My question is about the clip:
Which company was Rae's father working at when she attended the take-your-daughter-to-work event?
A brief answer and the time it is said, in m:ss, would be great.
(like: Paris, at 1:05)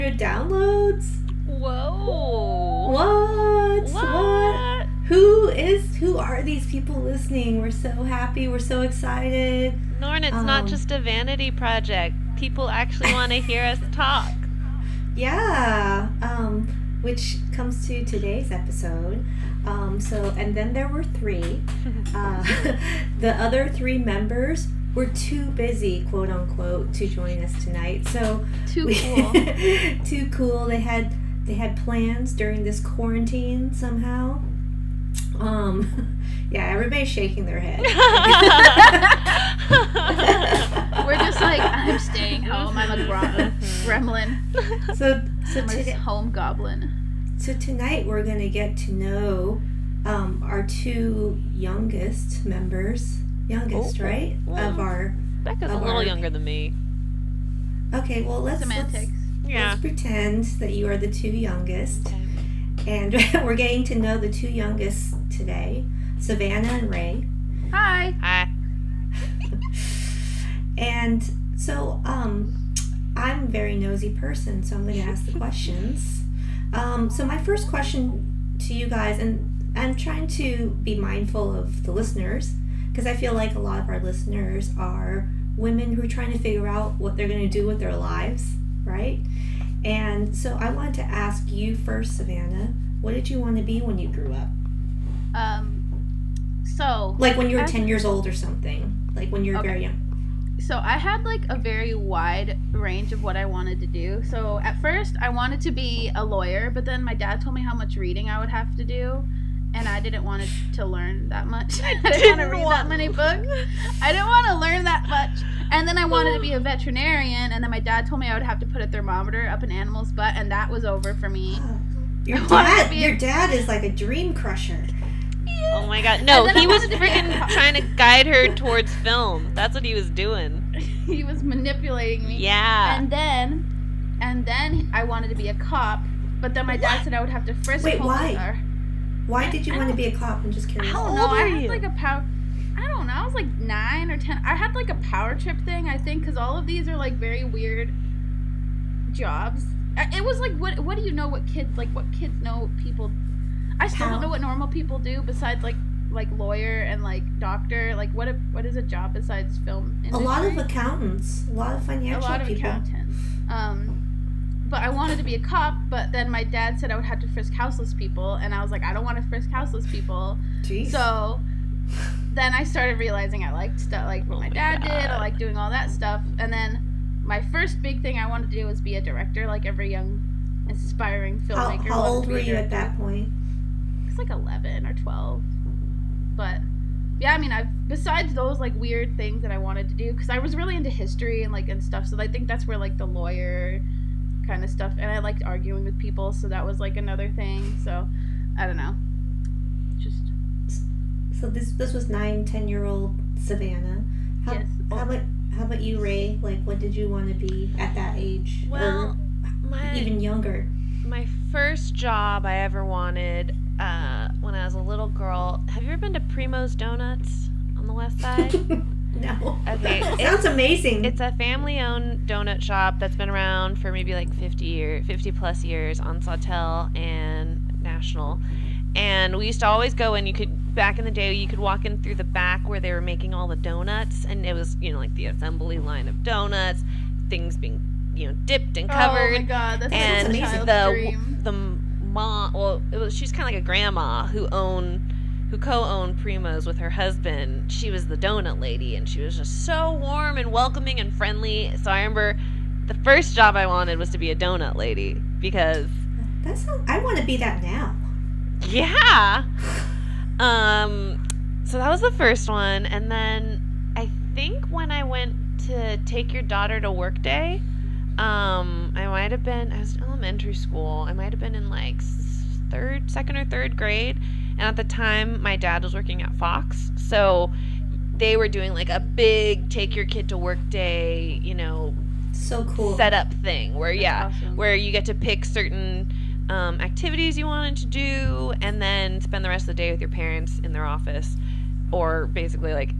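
Fox, at 4:36.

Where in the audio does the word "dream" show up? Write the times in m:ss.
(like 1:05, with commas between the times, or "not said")
2:03, 4:00.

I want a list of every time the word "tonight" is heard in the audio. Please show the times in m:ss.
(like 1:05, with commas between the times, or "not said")
0:27, 0:47.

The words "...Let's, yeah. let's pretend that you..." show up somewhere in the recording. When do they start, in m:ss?
0:58.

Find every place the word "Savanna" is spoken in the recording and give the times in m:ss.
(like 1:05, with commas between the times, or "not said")
1:06, 1:32, 3:23.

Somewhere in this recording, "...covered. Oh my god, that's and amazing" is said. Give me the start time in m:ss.
3:58.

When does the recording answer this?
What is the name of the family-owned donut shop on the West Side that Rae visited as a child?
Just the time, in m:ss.
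3:36.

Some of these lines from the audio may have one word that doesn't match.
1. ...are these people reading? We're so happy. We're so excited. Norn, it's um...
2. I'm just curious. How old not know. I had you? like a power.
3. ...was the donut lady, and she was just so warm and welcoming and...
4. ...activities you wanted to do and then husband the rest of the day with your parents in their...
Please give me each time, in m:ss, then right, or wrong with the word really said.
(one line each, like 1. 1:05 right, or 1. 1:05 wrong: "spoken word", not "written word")
1. 0:06 wrong: "listening", not "reading"
2. 2:20 right
3. 4:07 right
4. 4:46 wrong: "spend", not "husband".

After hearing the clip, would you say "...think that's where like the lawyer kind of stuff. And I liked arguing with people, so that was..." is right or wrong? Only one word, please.
right.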